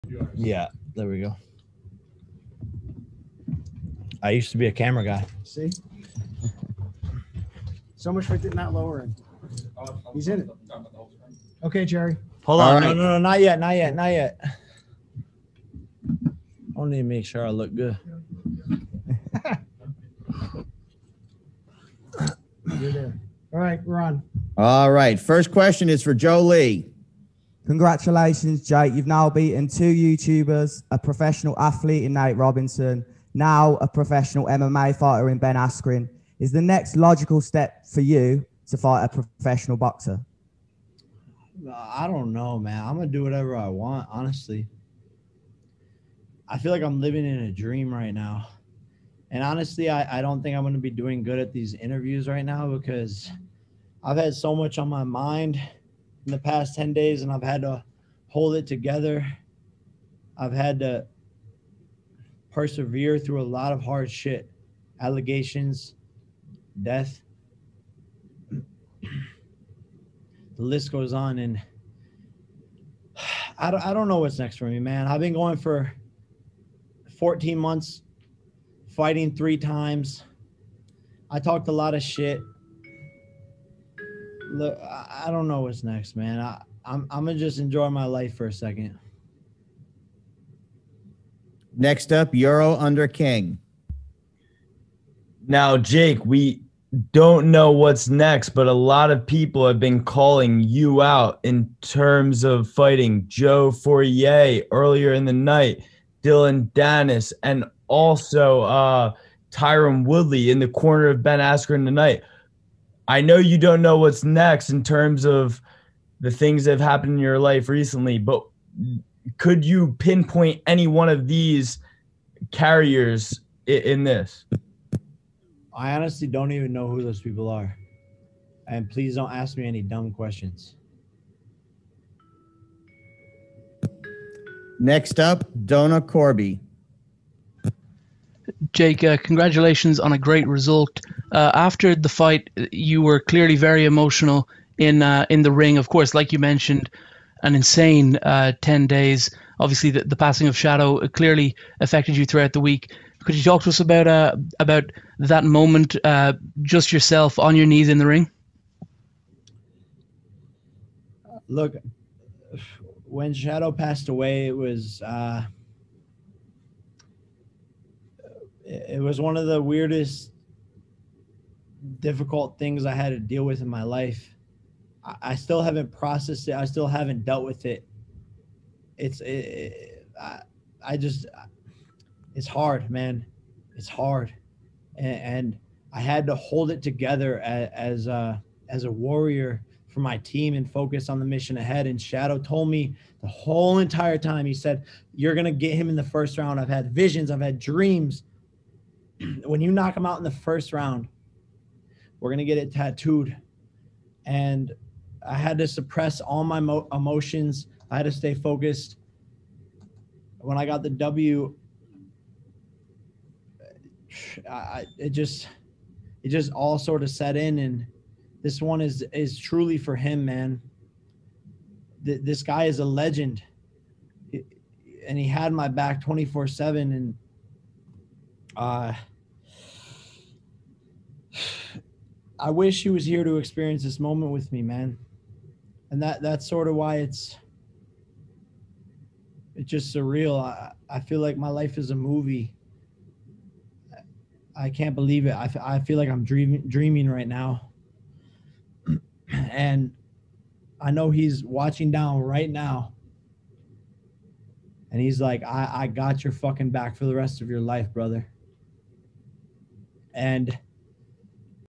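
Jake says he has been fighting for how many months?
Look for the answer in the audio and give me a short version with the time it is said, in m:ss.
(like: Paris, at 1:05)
14 months, at 1:17.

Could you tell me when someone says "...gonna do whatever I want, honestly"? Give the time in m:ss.
0:42.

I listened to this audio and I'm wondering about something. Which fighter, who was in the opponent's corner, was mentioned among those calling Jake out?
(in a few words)
Tyron Woodley.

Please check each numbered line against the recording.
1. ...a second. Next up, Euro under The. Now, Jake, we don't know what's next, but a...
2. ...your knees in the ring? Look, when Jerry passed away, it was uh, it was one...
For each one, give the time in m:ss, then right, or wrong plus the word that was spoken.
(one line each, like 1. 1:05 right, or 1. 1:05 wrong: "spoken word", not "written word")
1. 1:28 wrong: "King", not "The"
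2. 2:37 wrong: "Shadow", not "Jerry".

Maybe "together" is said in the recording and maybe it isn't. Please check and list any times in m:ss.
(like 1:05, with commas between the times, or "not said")
0:58, 3:06.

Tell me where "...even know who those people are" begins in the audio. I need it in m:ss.
2:06.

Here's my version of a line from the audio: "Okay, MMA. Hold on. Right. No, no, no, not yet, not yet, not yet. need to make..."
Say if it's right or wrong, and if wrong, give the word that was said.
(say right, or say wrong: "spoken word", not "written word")
wrong: "Jerry", not "MMA".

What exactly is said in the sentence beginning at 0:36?
Is the next logical step for you to fight a professional boxer?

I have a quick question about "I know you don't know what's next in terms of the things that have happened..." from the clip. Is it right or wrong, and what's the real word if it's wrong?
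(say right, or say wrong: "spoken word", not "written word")
right.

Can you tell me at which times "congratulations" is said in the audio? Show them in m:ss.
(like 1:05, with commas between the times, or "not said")
0:27, 2:19.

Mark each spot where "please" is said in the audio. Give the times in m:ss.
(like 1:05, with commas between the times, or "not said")
2:08.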